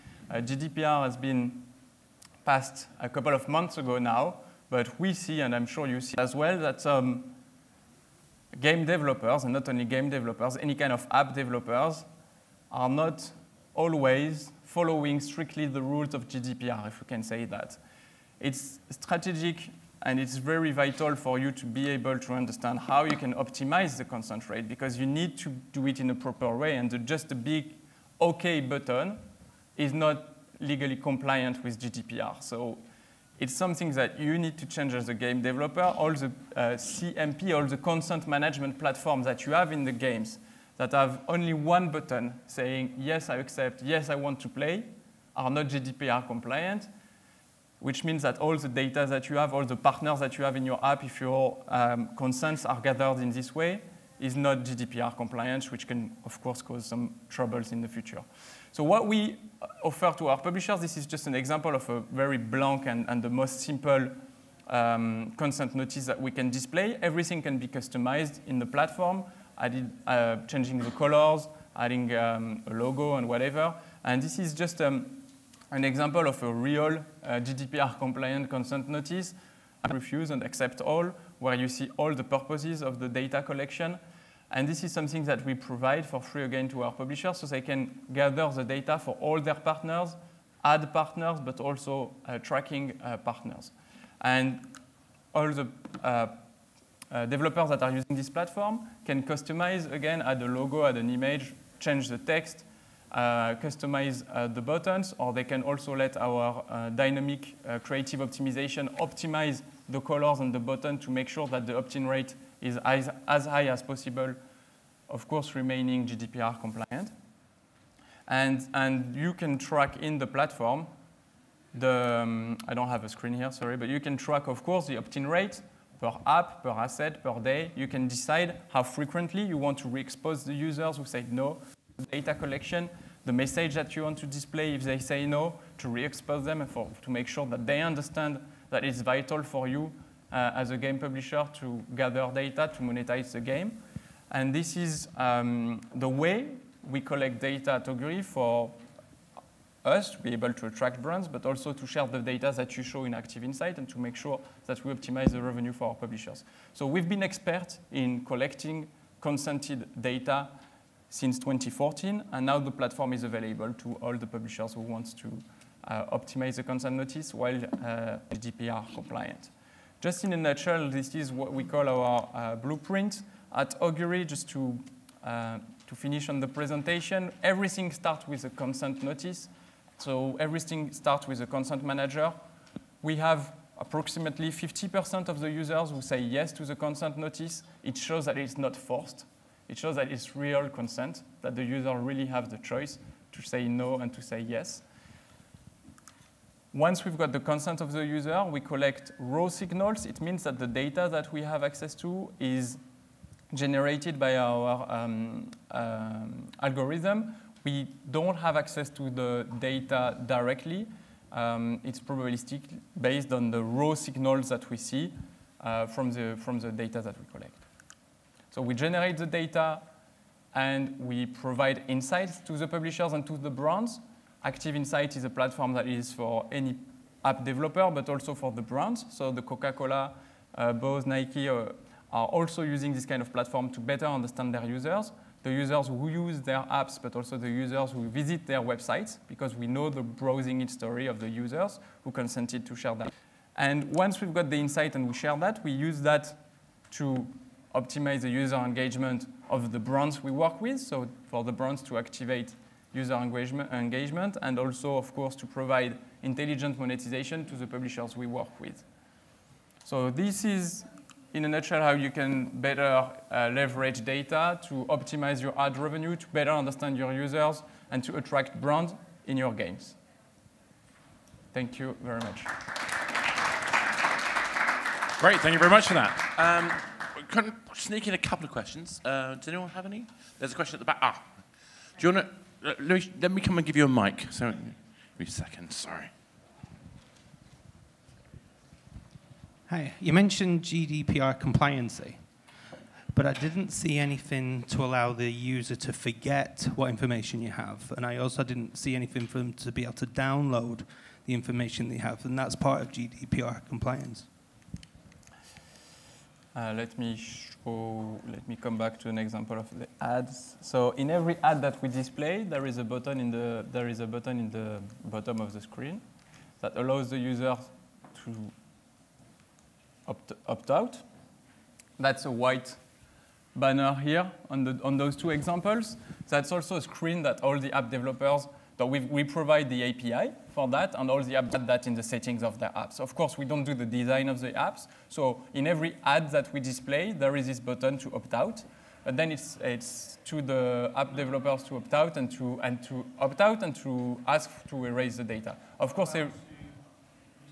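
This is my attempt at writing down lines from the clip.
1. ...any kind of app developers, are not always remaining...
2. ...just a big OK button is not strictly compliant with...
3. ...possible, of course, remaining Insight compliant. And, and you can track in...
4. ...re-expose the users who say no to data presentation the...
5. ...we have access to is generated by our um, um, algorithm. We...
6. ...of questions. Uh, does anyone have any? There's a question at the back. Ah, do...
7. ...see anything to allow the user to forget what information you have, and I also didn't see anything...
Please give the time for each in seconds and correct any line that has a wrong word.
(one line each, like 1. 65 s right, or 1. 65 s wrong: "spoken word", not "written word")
1. 10 s wrong: "following", not "remaining"
2. 26 s wrong: "legally", not "strictly"
3. 113 s wrong: "GDPR", not "Insight"
4. 129 s wrong: "collection", not "presentation"
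5. 201 s right
6. 278 s right
7. 293 s right.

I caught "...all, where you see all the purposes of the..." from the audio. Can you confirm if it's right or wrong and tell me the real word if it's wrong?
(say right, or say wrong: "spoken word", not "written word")
right.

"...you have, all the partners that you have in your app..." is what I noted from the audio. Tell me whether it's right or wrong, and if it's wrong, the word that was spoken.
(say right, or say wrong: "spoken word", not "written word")
right.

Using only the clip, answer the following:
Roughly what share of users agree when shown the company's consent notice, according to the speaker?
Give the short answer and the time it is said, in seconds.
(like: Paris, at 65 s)
50%, at 184 s.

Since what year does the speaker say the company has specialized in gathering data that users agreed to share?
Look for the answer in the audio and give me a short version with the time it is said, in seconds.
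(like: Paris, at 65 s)
2014, at 161 s.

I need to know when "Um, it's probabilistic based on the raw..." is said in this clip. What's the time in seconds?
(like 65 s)
211 s.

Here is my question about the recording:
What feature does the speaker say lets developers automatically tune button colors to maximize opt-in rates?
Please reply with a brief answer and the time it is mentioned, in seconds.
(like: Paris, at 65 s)
dynamic creative optimization, at 106 s.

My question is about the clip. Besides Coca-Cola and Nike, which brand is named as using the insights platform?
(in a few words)
Bose.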